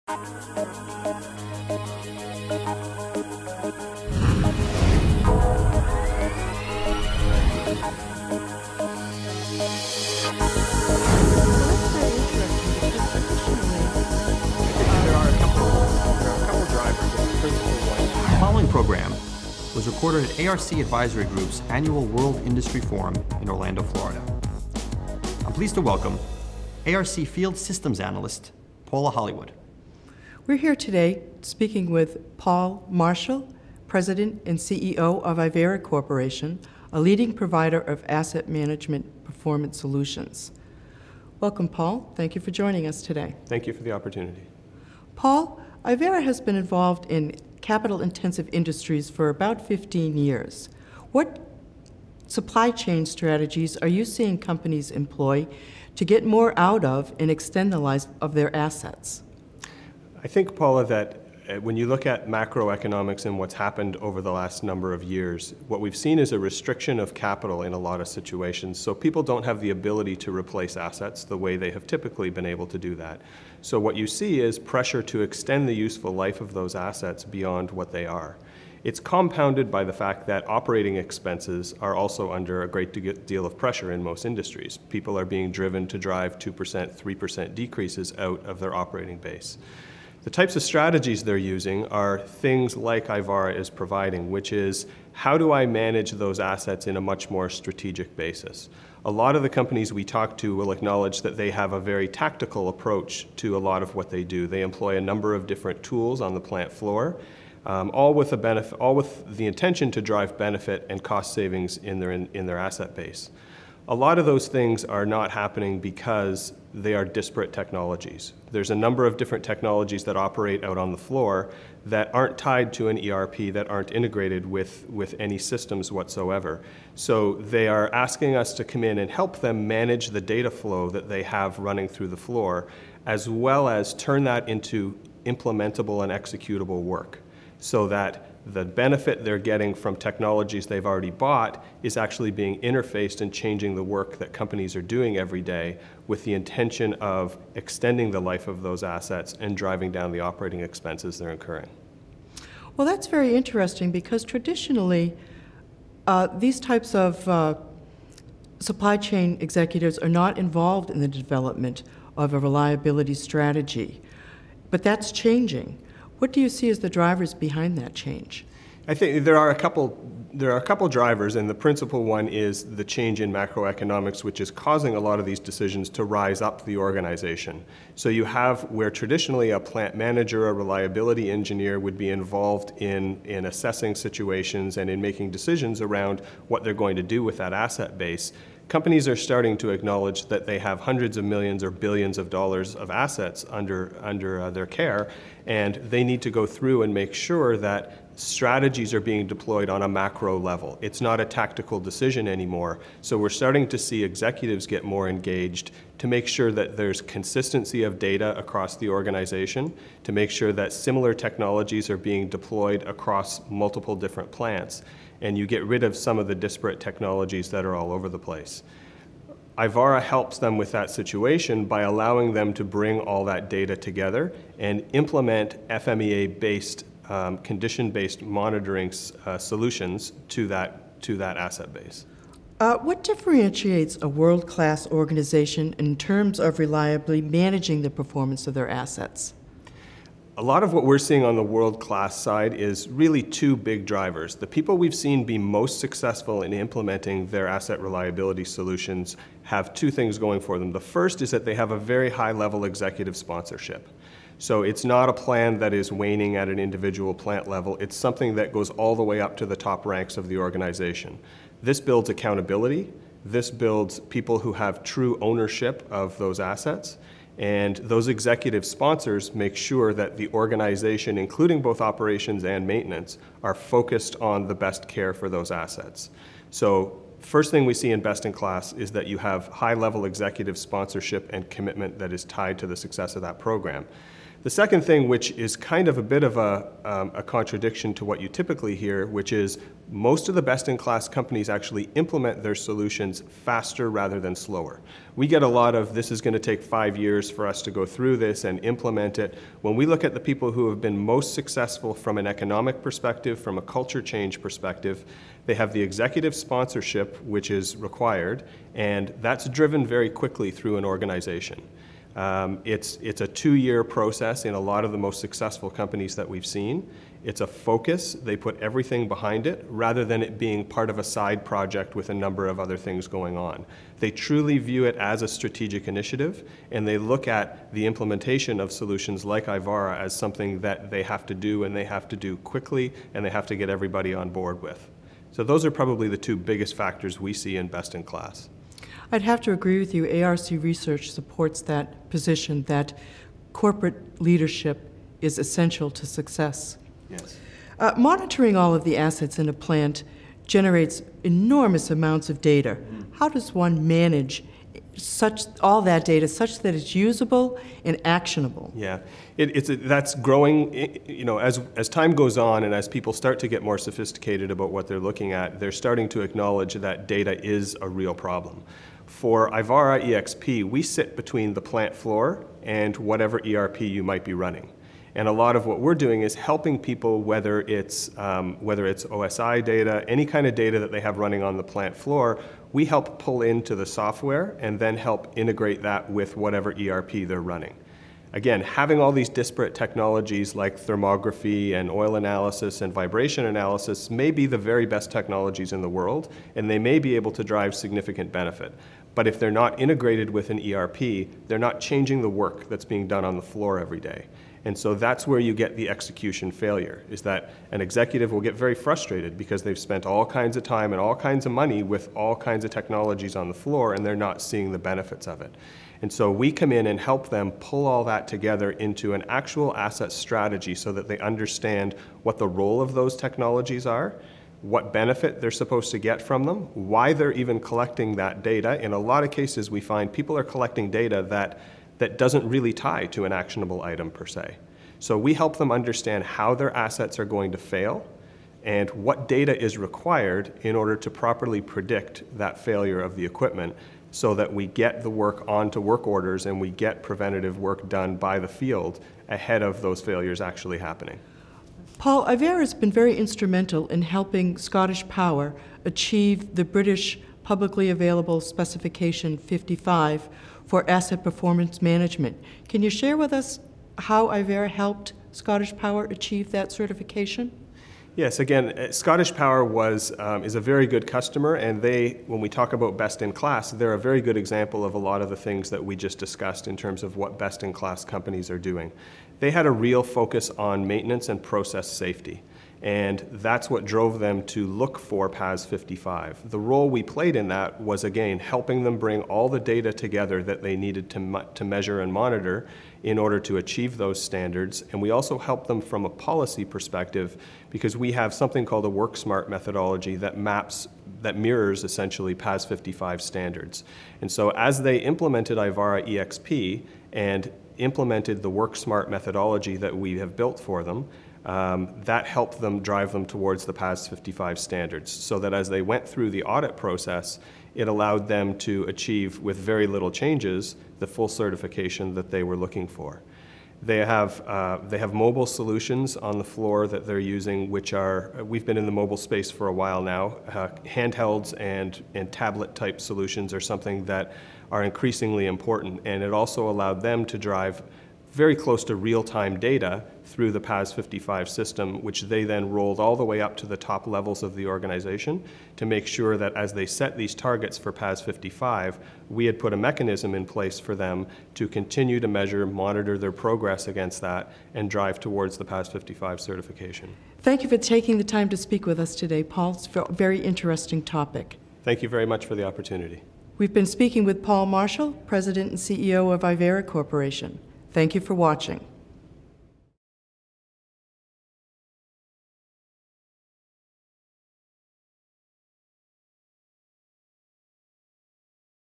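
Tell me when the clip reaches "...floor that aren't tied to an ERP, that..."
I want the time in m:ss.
2:00.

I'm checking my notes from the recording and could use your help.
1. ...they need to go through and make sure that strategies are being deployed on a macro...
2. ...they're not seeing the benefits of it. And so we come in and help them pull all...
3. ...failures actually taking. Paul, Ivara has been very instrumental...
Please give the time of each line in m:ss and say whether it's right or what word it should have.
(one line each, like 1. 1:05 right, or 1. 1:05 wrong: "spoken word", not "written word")
1. 3:15 right
2. 6:54 right
3. 7:30 wrong: "happening", not "taking".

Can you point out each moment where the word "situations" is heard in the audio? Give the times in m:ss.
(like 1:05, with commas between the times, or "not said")
1:08, 3:03, 3:40.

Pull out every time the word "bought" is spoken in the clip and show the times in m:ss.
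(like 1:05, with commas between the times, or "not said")
2:21.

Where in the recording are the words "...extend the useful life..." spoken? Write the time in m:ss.
1:15.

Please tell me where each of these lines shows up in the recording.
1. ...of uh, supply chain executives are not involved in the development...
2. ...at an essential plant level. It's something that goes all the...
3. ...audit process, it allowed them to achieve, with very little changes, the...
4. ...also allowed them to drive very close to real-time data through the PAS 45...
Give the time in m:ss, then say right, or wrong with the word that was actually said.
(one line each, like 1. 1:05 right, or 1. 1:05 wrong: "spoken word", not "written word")
1. 2:36 right
2. 4:16 wrong: "individual", not "essential"
3. 8:36 right
4. 8:56 wrong: "55", not "45".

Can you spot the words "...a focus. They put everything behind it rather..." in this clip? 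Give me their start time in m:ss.
5:17.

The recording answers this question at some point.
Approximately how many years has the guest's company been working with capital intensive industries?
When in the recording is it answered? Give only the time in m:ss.
0:49.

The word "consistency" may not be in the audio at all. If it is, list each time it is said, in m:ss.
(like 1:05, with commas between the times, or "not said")
3:27.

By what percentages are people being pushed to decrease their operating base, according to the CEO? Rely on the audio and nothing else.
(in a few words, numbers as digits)
2%, 3%.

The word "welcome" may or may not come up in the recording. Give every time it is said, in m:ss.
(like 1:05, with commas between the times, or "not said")
0:25, 0:41.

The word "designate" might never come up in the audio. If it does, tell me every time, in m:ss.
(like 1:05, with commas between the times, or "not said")
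not said.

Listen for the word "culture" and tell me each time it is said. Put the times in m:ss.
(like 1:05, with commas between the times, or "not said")
5:03.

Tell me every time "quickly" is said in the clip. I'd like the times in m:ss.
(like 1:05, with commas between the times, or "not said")
5:10, 5:32.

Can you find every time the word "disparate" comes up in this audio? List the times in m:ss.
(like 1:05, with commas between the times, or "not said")
1:57, 3:36, 6:29.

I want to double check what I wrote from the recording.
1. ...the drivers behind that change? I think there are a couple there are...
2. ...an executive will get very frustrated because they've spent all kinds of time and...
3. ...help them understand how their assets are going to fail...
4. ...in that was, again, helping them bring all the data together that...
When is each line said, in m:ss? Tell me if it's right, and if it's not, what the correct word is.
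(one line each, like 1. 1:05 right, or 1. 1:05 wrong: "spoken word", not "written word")
1. 2:46 right
2. 6:47 right
3. 7:15 right
4. 8:07 right.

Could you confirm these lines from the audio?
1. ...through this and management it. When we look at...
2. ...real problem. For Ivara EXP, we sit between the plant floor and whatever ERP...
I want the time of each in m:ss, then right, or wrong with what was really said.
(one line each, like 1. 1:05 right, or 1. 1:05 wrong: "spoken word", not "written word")
1. 4:57 wrong: "implement", not "management"
2. 6:07 right.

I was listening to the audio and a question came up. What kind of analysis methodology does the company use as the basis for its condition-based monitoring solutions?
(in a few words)
FMEA.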